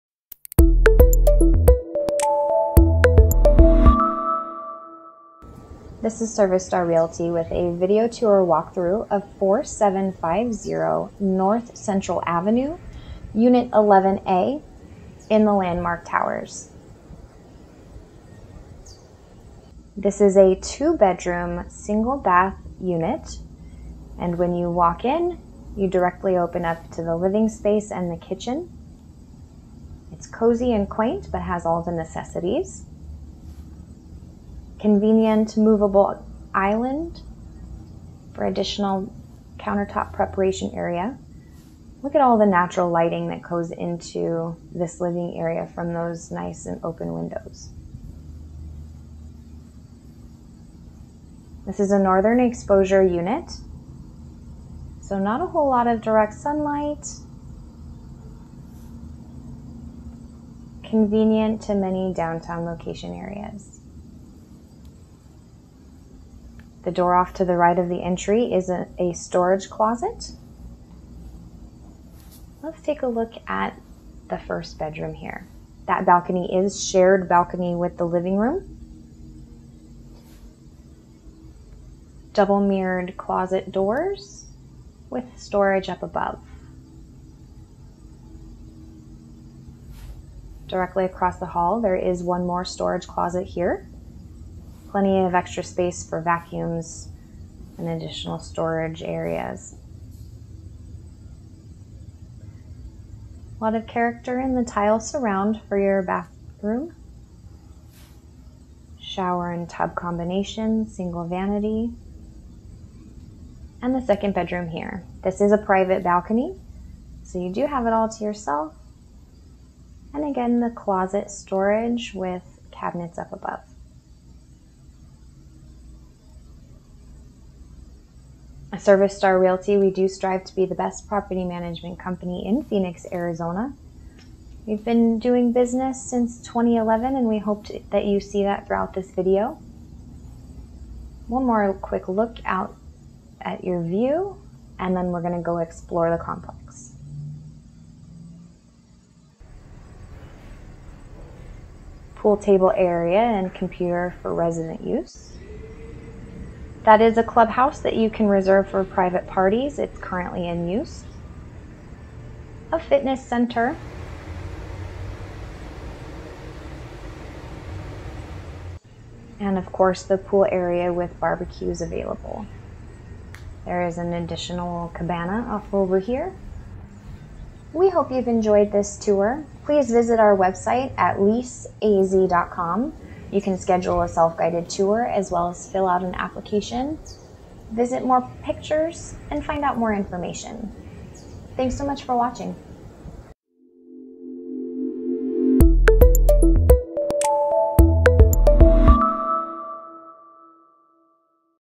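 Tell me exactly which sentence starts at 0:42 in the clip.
Look at all the natural lighting that goes into this living area from those nice and open windows.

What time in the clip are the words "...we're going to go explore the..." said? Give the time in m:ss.
2:25.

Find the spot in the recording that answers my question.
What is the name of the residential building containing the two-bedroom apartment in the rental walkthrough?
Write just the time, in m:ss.
0:15.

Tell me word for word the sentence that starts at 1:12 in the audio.
Let's take a look at the first bedroom here.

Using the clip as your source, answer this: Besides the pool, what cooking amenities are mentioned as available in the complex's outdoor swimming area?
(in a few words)
Barbecues.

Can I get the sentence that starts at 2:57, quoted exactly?
We hope you've enjoyed this tour.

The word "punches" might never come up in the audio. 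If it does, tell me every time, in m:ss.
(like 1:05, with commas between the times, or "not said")
not said.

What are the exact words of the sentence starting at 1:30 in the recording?
Directly across the hall, there is one more storage closet here plenty of extra space for vacuums and additional storage areas.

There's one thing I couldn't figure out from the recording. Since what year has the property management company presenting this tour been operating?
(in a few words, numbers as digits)
2011.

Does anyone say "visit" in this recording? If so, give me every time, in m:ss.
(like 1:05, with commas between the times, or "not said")
2:59, 3:07.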